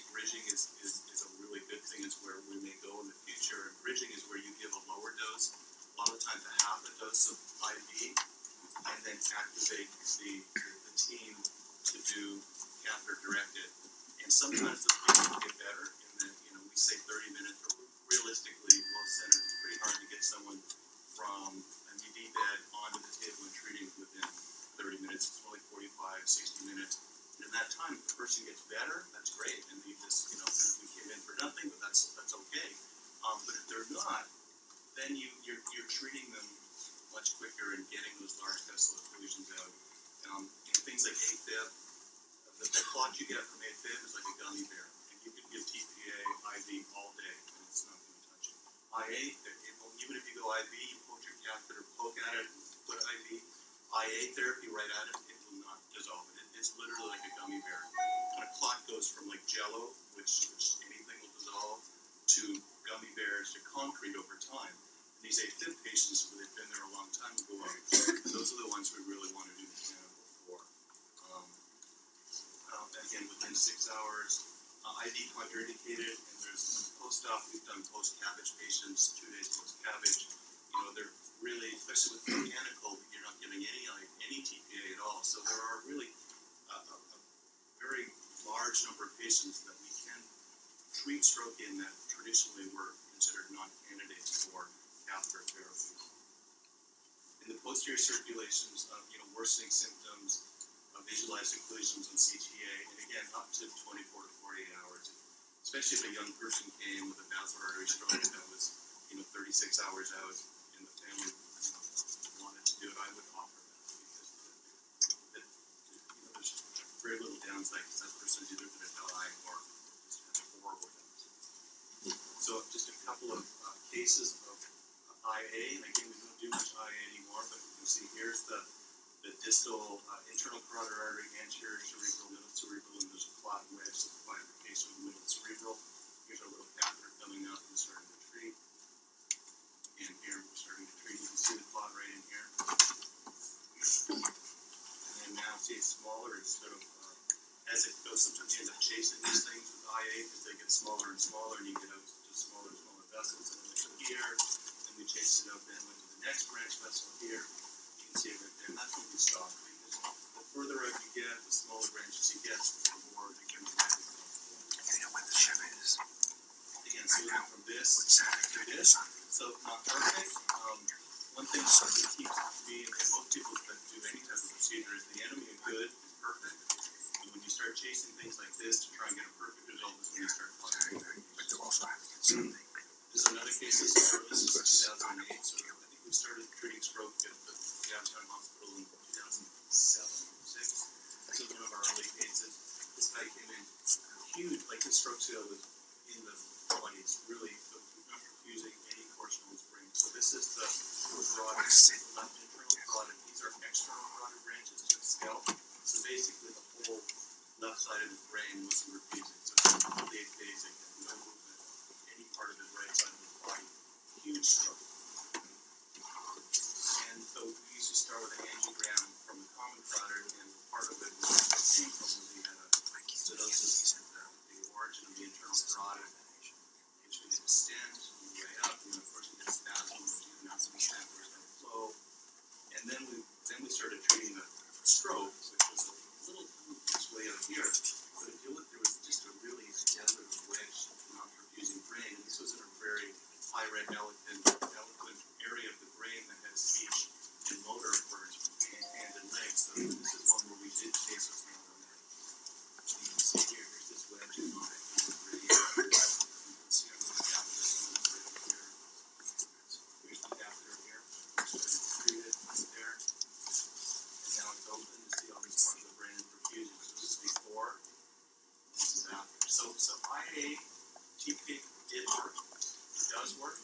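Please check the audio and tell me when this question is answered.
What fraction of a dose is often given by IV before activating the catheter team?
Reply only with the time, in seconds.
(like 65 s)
6 s.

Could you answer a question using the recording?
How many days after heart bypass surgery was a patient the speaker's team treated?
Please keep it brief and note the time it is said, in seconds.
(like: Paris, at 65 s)
2 days, at 79 s.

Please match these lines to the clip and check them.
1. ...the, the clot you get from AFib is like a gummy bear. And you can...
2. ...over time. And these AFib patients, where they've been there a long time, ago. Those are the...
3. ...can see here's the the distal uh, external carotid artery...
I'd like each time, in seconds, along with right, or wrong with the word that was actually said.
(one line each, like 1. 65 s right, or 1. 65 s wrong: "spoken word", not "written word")
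1. 42 s right
2. 64 s right
3. 127 s wrong: "internal", not "external".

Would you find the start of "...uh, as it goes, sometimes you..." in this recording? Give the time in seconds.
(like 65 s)
146 s.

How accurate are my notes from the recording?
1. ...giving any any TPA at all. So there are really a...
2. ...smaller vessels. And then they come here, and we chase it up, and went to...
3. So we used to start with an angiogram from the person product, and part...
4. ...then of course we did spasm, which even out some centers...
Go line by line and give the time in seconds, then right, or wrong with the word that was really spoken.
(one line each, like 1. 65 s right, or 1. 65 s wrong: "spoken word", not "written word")
1. 83 s right
2. 152 s right
3. 217 s wrong: "common", not "person"
4. 228 s wrong: "chambers", not "centers".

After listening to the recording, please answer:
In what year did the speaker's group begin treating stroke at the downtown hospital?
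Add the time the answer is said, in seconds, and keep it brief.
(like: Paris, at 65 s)
2007, at 189 s.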